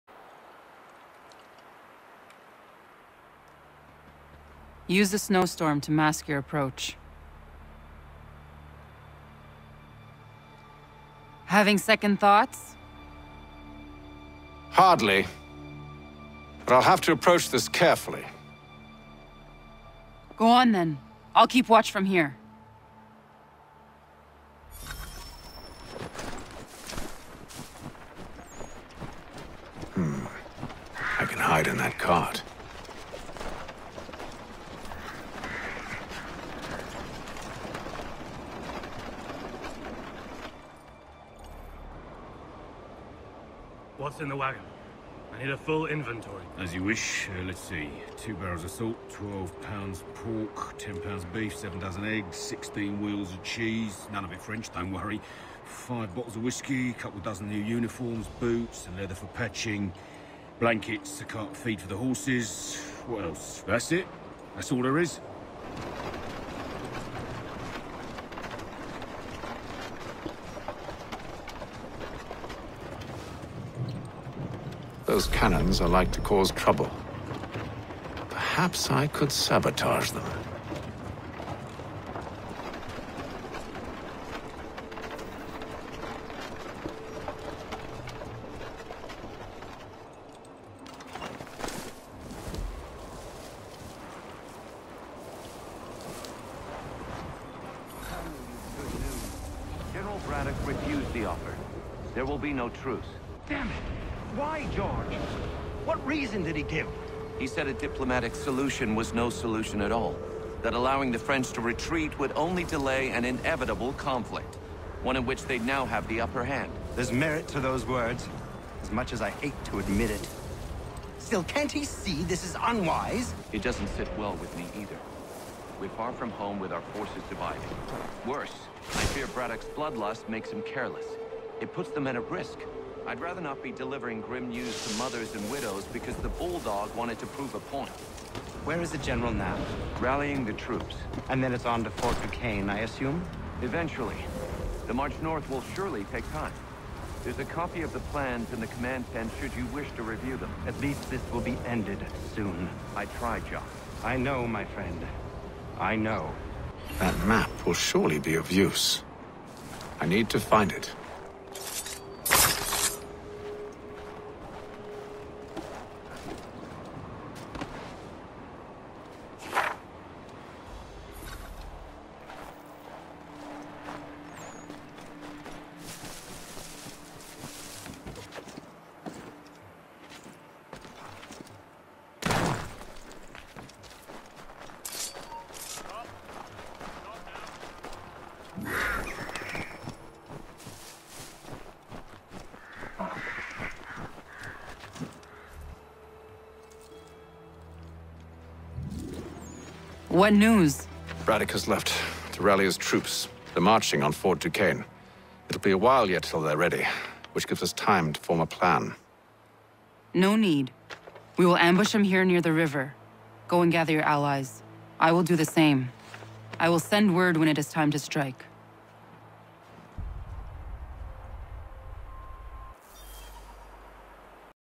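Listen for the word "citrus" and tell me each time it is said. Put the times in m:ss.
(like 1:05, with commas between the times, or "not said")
not said.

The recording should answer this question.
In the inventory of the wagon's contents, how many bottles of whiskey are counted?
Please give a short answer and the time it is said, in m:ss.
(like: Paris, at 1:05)
5, at 0:55.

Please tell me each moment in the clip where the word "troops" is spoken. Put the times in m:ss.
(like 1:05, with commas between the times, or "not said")
2:20, 3:22.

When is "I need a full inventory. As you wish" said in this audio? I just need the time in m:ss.
0:45.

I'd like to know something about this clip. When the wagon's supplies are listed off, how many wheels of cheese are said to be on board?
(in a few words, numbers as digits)
16.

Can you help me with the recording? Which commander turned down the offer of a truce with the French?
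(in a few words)
General Braddock.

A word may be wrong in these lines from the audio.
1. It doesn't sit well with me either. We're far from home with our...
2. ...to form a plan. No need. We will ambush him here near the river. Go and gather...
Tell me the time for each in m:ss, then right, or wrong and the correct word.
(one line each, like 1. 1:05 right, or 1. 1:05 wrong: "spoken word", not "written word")
1. 2:03 right
2. 3:28 right.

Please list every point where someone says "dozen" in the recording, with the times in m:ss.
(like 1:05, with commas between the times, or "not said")
0:51, 0:57.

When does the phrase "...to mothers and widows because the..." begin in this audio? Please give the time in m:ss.
2:14.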